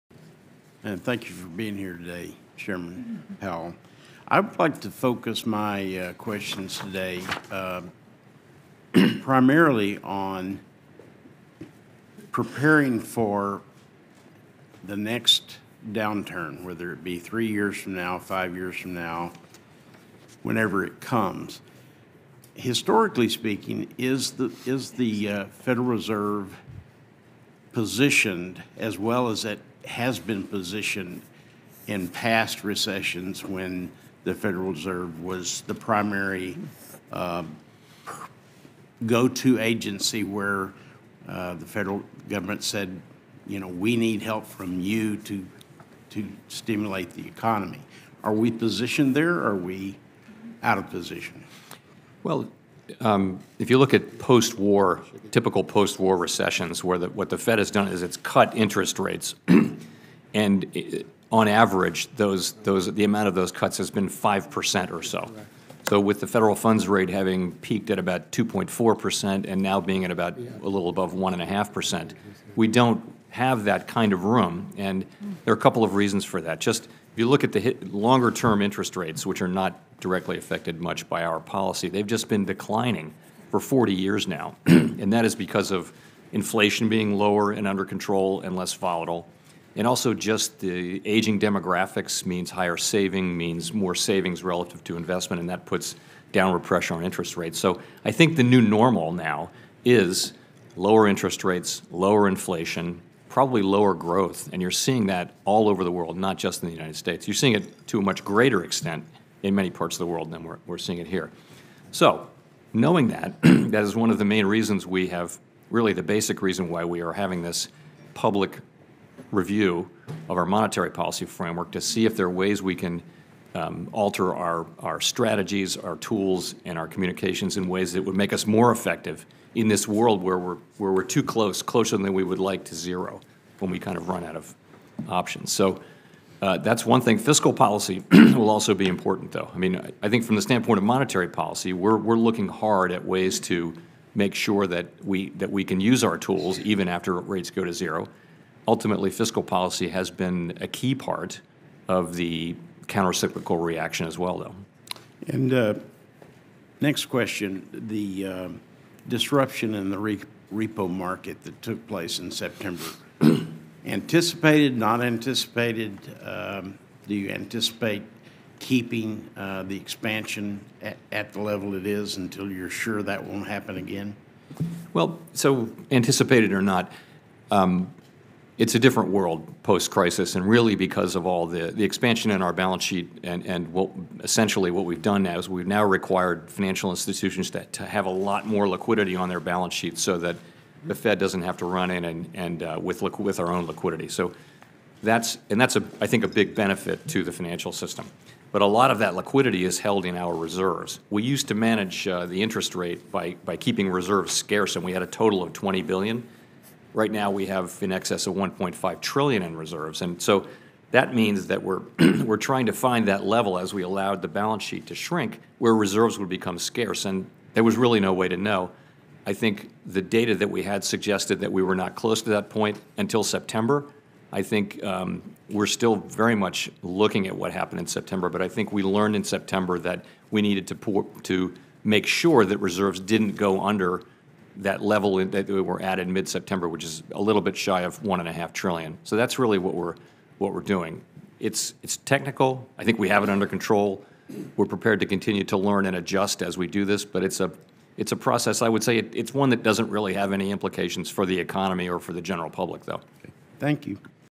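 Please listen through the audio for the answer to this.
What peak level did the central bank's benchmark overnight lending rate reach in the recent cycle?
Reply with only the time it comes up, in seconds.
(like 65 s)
68 s.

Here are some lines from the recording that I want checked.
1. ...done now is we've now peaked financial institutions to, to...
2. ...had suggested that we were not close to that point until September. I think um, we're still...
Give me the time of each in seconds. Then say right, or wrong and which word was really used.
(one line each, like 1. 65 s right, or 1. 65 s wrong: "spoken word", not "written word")
1. 185 s wrong: "required", not "peaked"
2. 220 s right.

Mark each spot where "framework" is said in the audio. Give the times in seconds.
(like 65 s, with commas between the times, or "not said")
121 s.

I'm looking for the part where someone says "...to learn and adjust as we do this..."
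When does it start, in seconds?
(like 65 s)
245 s.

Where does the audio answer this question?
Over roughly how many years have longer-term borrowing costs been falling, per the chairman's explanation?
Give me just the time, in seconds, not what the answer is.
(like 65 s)
83 s.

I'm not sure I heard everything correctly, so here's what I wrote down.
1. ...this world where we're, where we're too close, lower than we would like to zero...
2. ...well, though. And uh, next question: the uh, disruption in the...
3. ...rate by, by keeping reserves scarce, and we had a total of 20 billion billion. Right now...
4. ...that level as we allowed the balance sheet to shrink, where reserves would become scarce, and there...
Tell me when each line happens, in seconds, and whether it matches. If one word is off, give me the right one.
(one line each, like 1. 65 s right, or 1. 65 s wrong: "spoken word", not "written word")
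1. 129 s wrong: "closer", not "lower"
2. 154 s right
3. 202 s right
4. 213 s right.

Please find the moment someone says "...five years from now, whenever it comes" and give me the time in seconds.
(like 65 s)
18 s.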